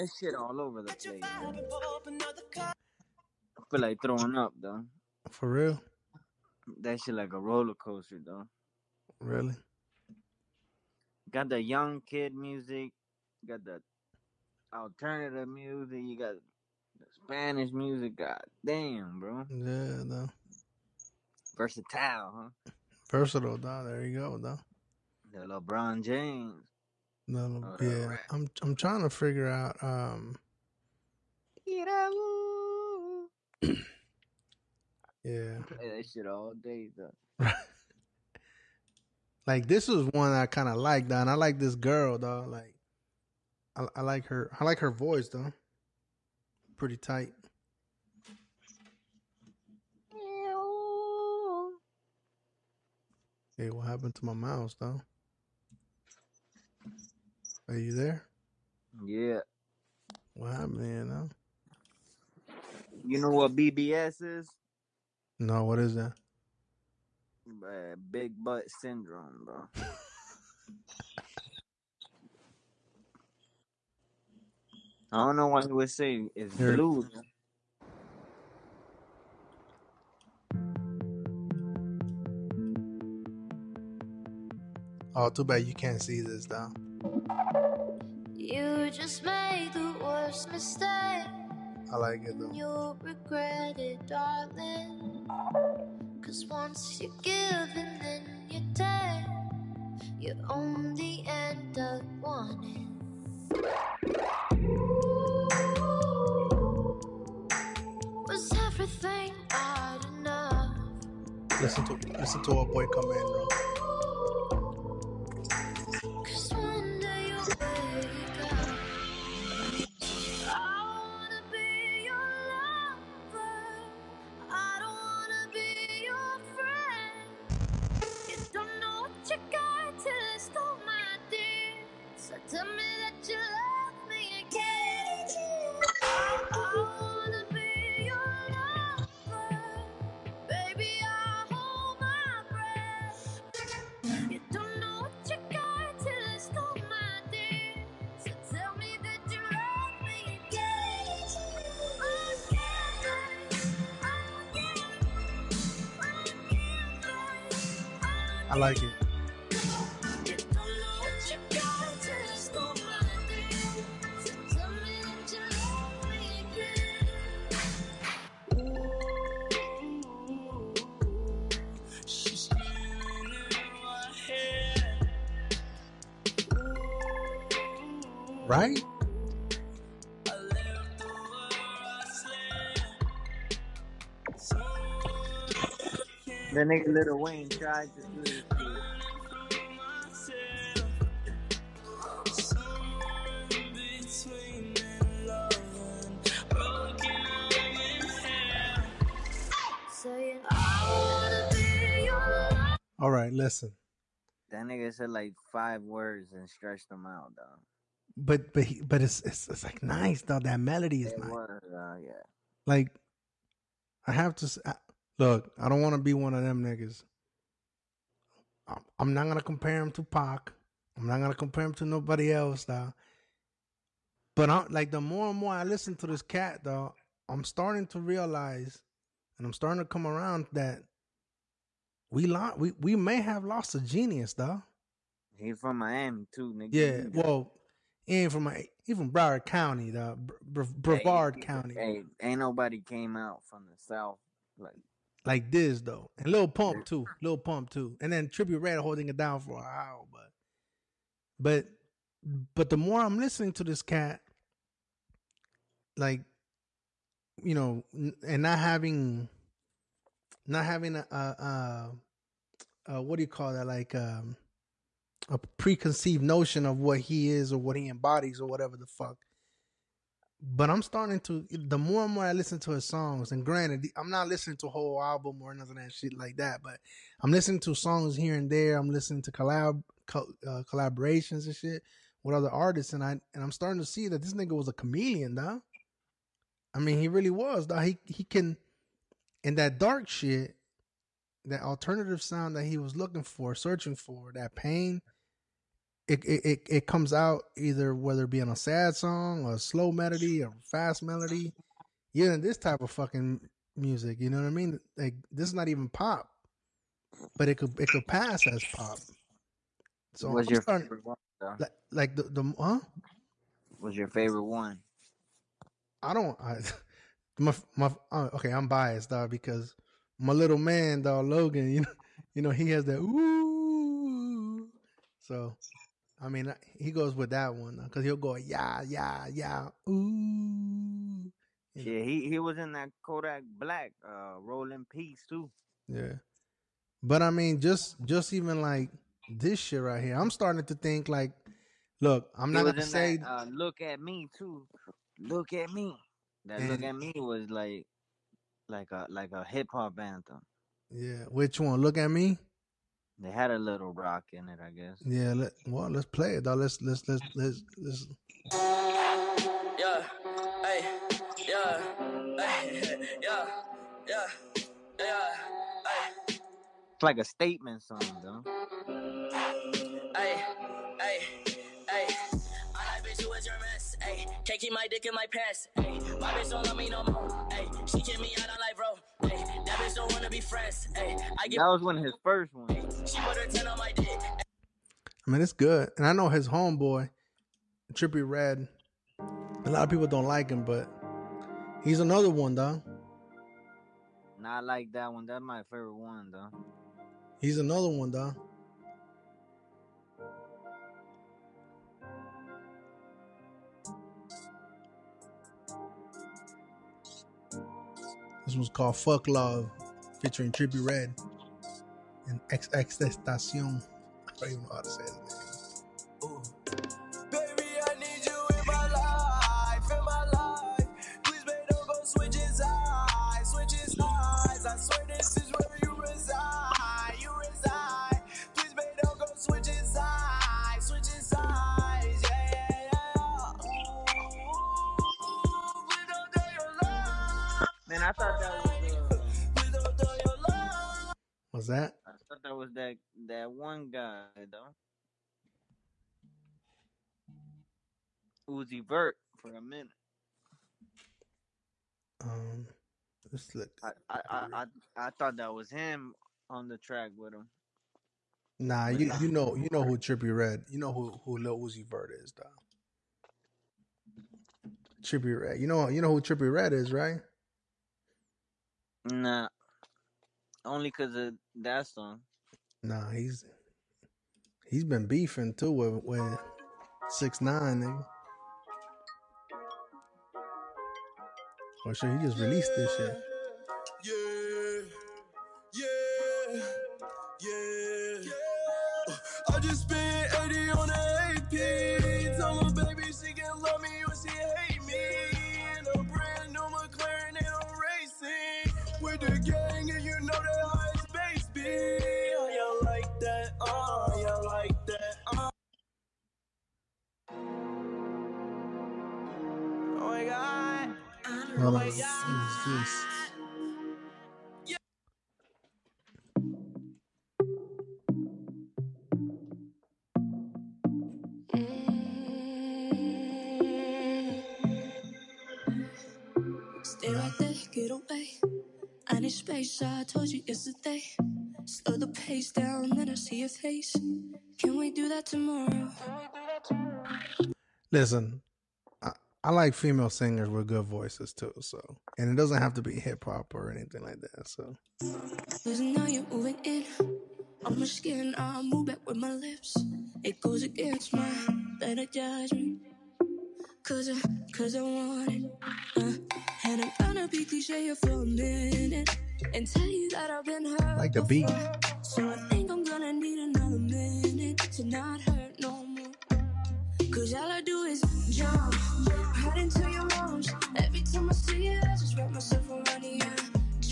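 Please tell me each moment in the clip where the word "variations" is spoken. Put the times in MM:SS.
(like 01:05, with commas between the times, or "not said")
not said.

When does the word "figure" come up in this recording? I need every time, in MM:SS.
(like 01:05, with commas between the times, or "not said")
00:29.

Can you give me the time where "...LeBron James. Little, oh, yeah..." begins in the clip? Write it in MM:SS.
00:25.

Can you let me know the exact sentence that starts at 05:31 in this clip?
You yeah, he he was in that Kodak Black, uh, Roll in Peace too.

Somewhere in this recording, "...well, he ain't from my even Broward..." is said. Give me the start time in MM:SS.
03:57.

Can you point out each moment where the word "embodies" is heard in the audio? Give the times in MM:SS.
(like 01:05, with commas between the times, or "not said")
04:27.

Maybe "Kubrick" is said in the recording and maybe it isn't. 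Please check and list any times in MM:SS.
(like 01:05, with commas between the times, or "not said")
not said.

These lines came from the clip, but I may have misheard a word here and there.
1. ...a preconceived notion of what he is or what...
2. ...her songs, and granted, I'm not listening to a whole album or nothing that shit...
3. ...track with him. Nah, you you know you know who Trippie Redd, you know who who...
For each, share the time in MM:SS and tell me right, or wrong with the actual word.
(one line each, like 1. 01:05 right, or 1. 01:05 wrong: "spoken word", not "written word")
1. 04:25 right
2. 04:32 right
3. 07:36 right.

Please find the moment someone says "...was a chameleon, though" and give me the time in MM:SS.
04:44.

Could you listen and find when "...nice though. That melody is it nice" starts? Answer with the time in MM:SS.
03:29.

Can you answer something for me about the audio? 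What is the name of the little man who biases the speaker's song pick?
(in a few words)
Logan.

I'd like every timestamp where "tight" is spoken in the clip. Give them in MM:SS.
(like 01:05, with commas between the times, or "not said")
00:46.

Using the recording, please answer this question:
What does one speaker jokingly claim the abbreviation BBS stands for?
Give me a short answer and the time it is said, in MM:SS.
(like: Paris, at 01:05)
Big butt syndrome, at 01:08.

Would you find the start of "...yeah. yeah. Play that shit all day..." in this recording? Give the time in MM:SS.
00:31.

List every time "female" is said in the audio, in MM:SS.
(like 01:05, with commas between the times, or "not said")
08:59.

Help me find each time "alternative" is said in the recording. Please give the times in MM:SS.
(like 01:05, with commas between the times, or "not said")
00:14, 04:51.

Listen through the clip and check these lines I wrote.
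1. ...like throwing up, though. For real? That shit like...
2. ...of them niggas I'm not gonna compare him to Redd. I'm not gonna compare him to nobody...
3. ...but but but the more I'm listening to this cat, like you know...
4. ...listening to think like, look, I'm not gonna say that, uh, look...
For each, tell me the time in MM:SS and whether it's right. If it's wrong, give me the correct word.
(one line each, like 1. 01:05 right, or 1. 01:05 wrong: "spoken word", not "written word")
1. 00:03 right
2. 03:36 wrong: "Pac", not "Redd"
3. 04:10 right
4. 05:40 wrong: "starting", not "listening".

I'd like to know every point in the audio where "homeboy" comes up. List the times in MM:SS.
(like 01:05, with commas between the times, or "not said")
06:26.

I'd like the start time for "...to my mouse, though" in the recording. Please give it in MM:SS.
00:54.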